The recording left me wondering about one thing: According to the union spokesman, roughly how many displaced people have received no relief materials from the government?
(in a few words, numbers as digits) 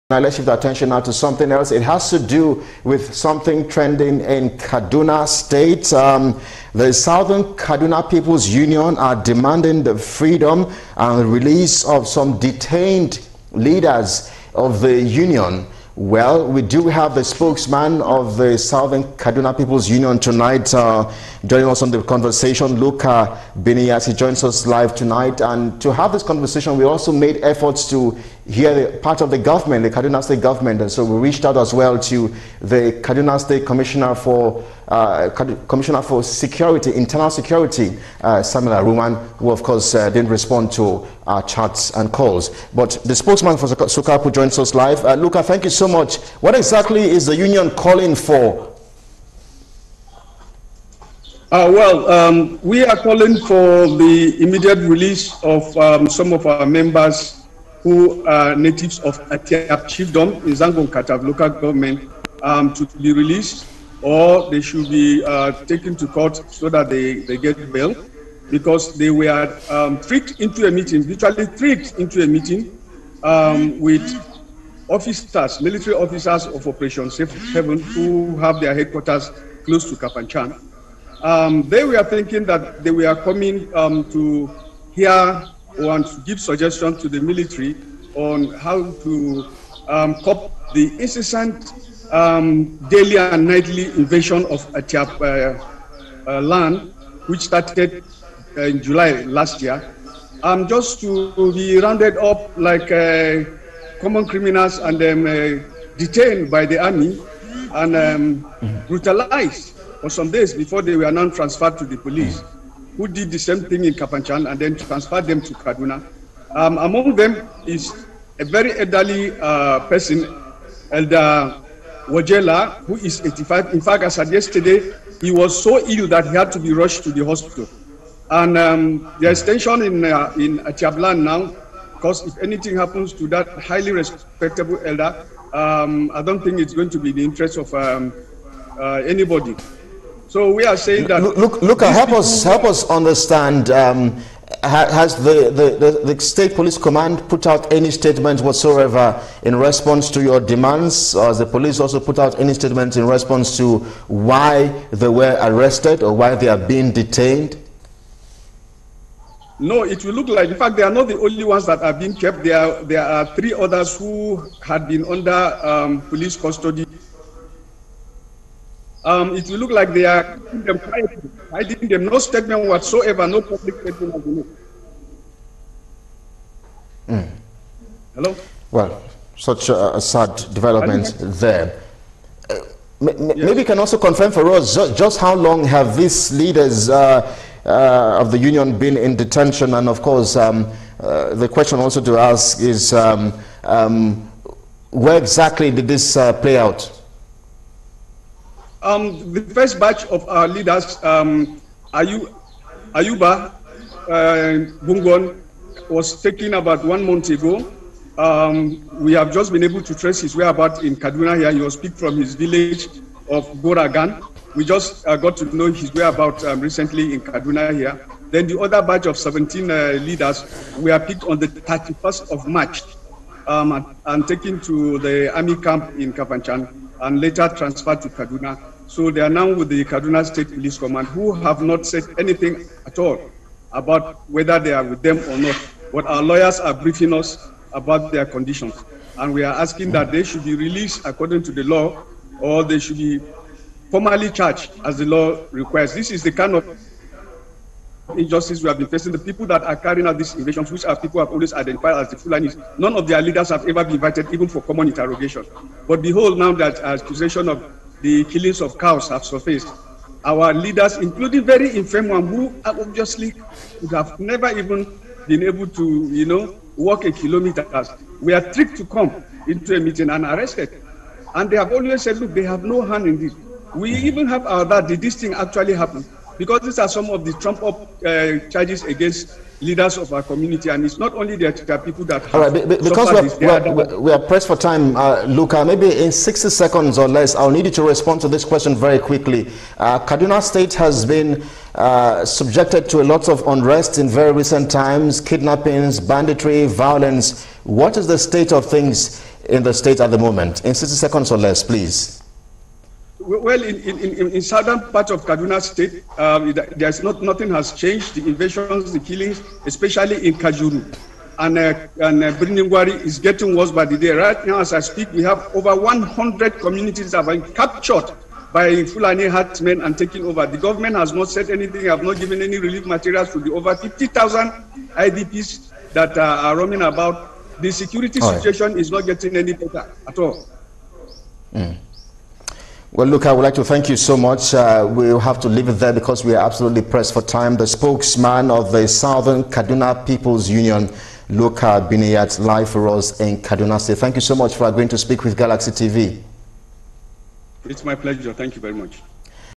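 50,000.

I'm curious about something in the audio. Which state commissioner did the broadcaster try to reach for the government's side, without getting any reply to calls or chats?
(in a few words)
Samuel Aruwan.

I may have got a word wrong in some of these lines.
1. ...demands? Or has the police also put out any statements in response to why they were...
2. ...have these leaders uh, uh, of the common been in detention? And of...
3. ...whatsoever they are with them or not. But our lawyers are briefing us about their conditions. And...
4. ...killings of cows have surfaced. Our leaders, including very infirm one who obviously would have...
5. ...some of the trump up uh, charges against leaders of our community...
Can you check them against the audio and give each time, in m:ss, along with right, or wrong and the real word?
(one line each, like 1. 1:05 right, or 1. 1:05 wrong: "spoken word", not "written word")
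1. 2:30 right
2. 3:05 wrong: "union", not "common"
3. 3:54 wrong: "whether", not "whatsoever"
4. 4:18 right
5. 4:36 right.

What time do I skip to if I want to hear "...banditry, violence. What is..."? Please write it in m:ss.
4:55.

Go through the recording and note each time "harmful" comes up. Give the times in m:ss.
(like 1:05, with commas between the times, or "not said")
not said.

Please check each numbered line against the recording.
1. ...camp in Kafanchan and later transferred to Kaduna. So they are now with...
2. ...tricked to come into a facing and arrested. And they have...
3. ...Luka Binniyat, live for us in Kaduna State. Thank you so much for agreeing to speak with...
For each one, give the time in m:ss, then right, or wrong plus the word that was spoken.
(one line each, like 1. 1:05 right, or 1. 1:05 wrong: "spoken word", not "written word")
1. 3:45 right
2. 4:28 wrong: "meeting", not "facing"
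3. 5:41 right.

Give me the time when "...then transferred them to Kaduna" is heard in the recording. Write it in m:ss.
1:54.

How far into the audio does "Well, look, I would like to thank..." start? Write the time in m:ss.
5:32.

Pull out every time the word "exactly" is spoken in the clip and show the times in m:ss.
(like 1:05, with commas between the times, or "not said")
0:46, 3:15.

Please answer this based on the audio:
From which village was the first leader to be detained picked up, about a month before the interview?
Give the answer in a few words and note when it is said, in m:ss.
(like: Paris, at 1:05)
Goragan, at 3:33.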